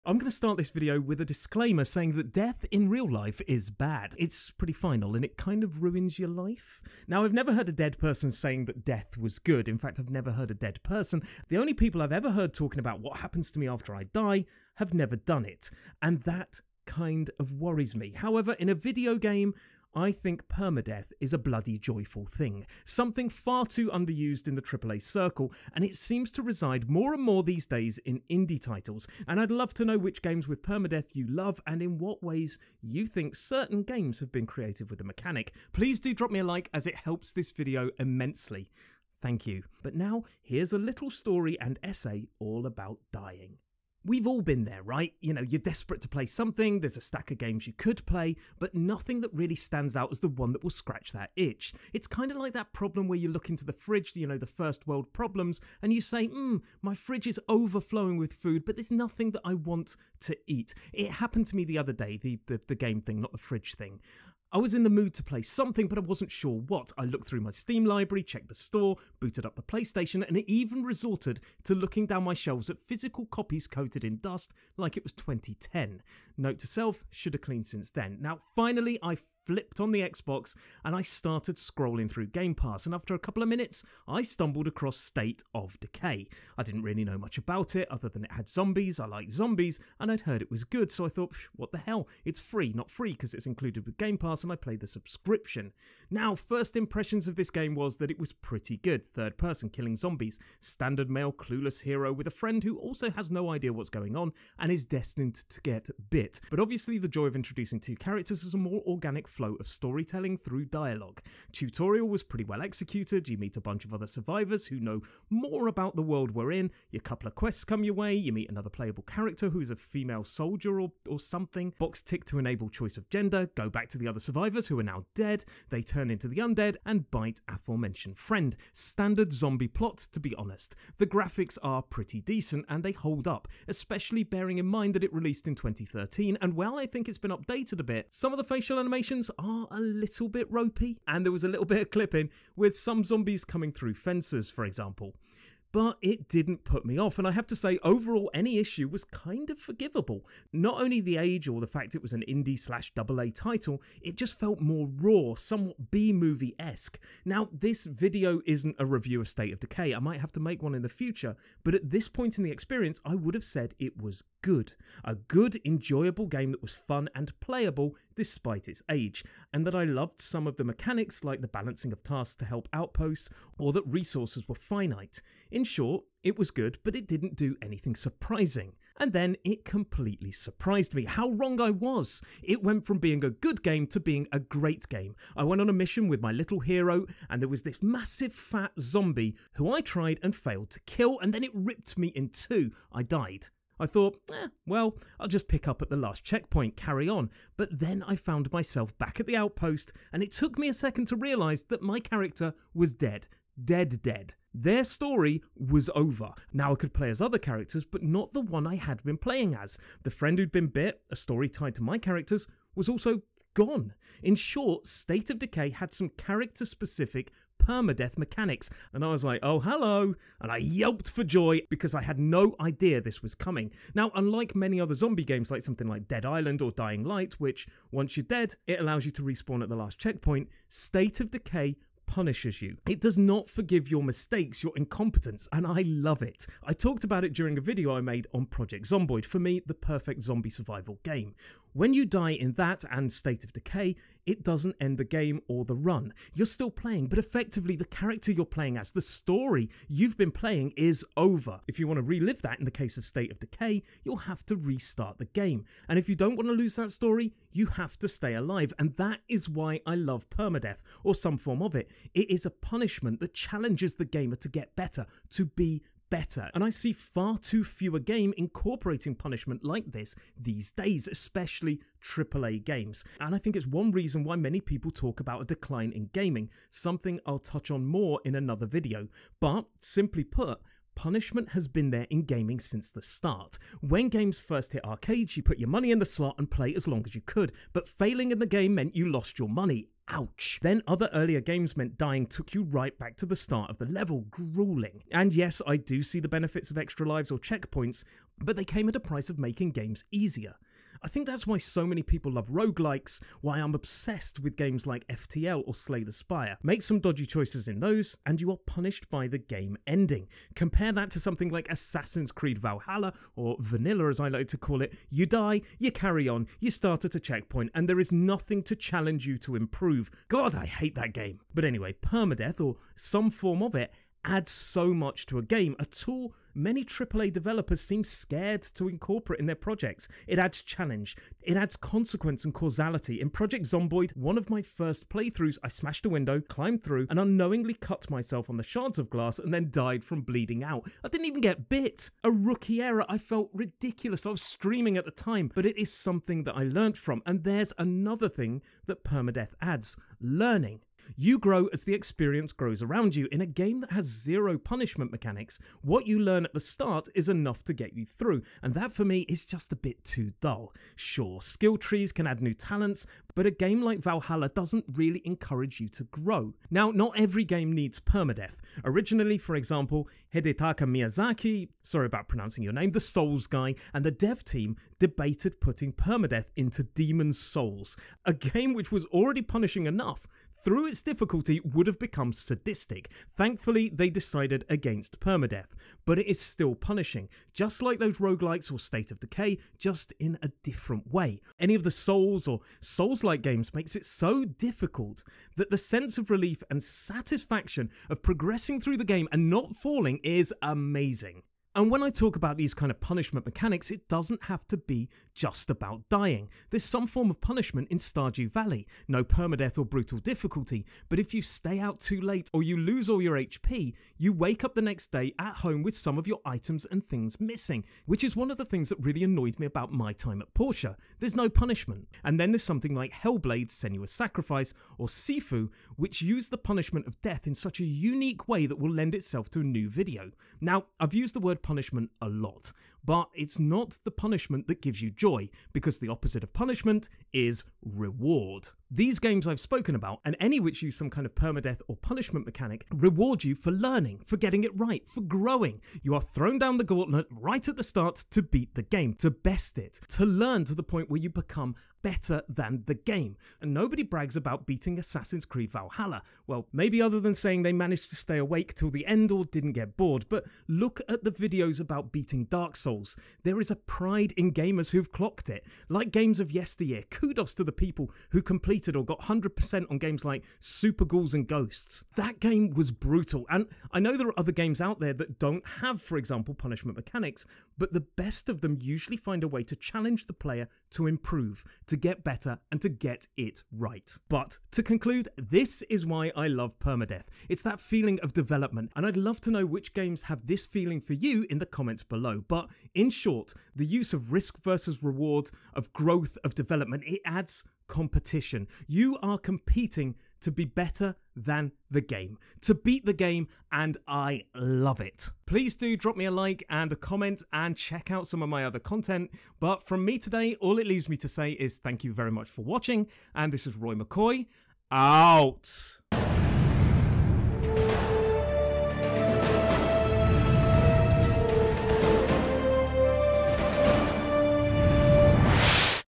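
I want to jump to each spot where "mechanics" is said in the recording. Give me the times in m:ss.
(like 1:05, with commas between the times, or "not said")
0:35, 2:50, 3:38, 5:55, 6:43, 7:22, 7:56.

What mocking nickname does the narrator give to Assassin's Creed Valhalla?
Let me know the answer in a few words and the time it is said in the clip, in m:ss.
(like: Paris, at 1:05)
Vanilla, at 5:13.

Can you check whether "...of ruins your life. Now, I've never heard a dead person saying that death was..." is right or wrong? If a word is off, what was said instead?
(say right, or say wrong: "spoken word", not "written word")
right.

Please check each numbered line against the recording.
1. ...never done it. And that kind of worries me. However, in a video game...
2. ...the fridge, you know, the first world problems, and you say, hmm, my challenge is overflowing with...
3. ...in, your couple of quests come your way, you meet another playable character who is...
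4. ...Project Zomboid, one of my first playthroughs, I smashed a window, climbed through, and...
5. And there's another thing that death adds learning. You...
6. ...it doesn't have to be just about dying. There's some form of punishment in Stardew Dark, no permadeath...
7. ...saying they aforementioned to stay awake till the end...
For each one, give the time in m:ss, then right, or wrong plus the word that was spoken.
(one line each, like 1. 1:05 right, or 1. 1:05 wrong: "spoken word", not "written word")
1. 0:14 right
2. 0:53 wrong: "fridge", not "challenge"
3. 1:56 right
4. 5:33 right
5. 5:47 wrong: "permadeath", not "death"
6. 6:43 wrong: "Valley", not "Dark"
7. 7:37 wrong: "managed", not "aforementioned".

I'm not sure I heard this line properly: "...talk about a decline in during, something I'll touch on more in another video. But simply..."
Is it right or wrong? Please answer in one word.
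wrong.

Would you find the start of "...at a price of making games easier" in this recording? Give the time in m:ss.
4:58.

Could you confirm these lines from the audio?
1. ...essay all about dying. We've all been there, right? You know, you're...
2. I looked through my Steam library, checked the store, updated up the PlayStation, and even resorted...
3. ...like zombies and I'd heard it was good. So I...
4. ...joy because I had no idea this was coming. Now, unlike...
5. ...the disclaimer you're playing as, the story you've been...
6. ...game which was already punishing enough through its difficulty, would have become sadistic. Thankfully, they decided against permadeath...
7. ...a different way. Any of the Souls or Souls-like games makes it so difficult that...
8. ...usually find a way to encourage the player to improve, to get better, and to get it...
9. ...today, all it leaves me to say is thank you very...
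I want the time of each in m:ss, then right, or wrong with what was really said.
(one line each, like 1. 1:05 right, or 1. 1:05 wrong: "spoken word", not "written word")
1. 0:41 right
2. 1:06 wrong: "booted", not "updated"
3. 1:29 right
4. 3:41 right
5. 4:07 wrong: "character", not "disclaimer"
6. 6:18 right
7. 6:30 right
8. 7:58 wrong: "challenge", not "encourage"
9. 8:30 right.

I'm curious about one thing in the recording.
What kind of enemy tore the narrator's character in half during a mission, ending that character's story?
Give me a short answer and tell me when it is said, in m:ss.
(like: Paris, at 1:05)
massive fat zombie, at 3:07.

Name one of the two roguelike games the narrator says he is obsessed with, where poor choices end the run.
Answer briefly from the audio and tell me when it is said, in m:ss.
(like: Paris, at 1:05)
FTL, at 5:05.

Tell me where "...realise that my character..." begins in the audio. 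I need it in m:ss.
3:21.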